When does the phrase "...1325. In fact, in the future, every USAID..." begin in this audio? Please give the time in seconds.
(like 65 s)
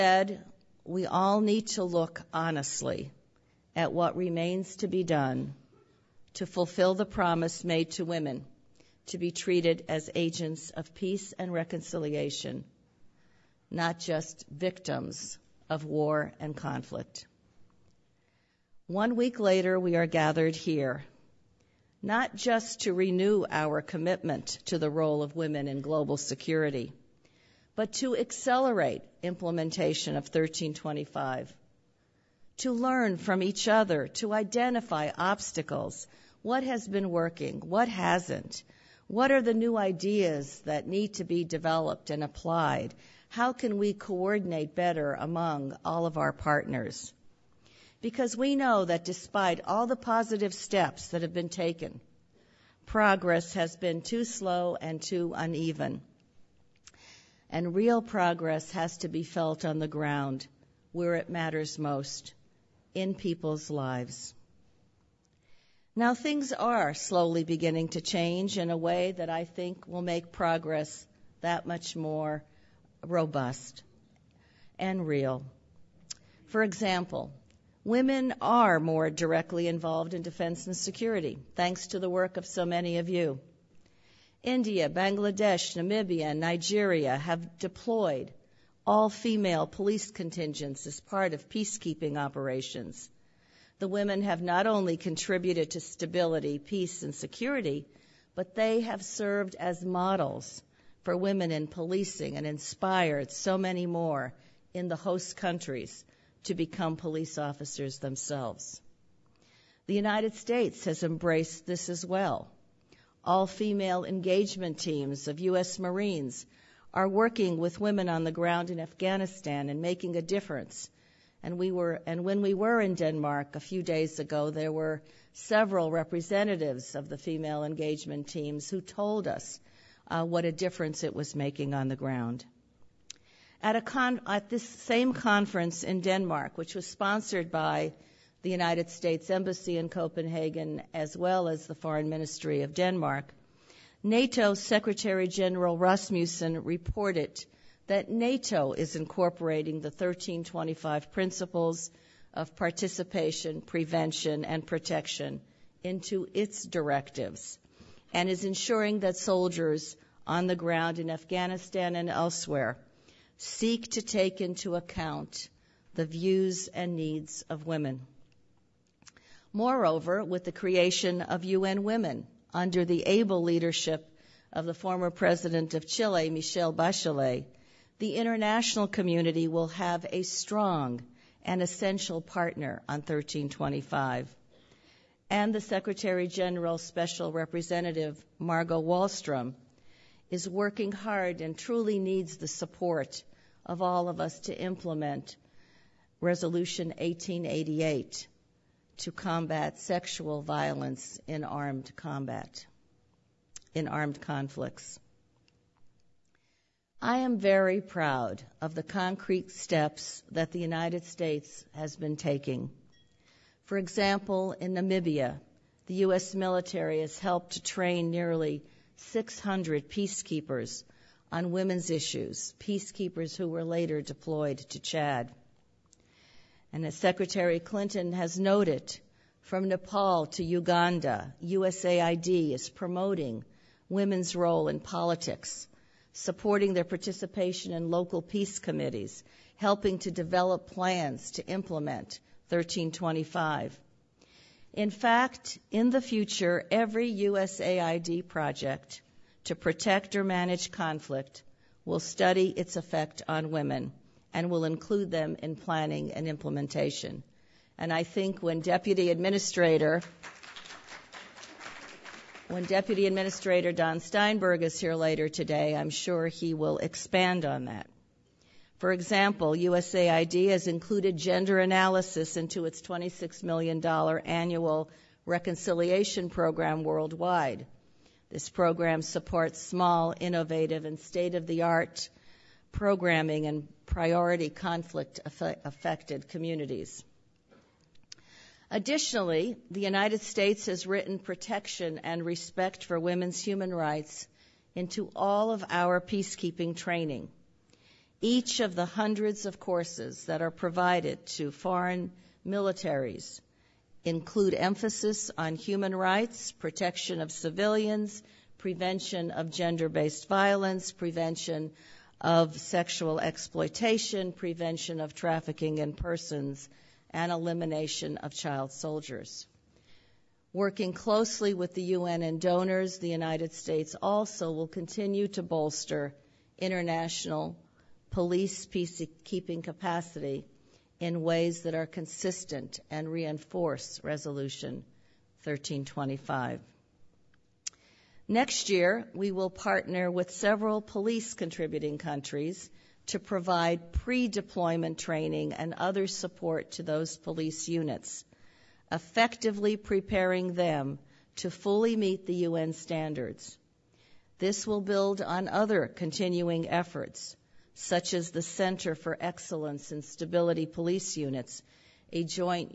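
242 s.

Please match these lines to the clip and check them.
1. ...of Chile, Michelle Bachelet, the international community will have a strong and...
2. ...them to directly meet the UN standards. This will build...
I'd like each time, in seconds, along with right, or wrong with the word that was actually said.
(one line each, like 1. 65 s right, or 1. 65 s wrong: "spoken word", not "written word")
1. 175 s right
2. 350 s wrong: "fully", not "directly".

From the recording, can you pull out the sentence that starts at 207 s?
I am very proud of the concrete steps that the United States has been taking.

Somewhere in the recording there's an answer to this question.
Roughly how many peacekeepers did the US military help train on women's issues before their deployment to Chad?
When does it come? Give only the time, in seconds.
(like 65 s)
218 s.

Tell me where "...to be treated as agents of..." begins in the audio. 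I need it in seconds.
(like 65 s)
9 s.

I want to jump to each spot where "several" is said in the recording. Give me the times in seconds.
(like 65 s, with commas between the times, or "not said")
125 s, 340 s.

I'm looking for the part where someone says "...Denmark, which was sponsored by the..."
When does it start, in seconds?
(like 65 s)
136 s.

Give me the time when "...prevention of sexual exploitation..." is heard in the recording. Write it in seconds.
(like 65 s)
310 s.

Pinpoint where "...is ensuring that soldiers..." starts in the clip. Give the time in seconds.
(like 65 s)
158 s.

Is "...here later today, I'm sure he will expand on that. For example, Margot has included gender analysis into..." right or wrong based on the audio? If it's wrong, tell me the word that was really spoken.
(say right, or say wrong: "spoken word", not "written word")
wrong: "USAID", not "Margot".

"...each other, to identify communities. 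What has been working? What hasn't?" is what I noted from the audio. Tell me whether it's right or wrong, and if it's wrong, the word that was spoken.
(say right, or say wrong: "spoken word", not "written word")
wrong: "obstacles", not "communities".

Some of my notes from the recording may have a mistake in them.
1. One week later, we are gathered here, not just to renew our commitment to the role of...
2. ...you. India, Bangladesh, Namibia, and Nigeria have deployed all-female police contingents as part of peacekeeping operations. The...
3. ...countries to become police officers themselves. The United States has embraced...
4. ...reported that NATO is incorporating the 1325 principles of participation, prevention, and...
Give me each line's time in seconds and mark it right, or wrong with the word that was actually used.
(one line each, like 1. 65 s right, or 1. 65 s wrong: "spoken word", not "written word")
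1. 18 s right
2. 83 s right
3. 105 s right
4. 146 s right.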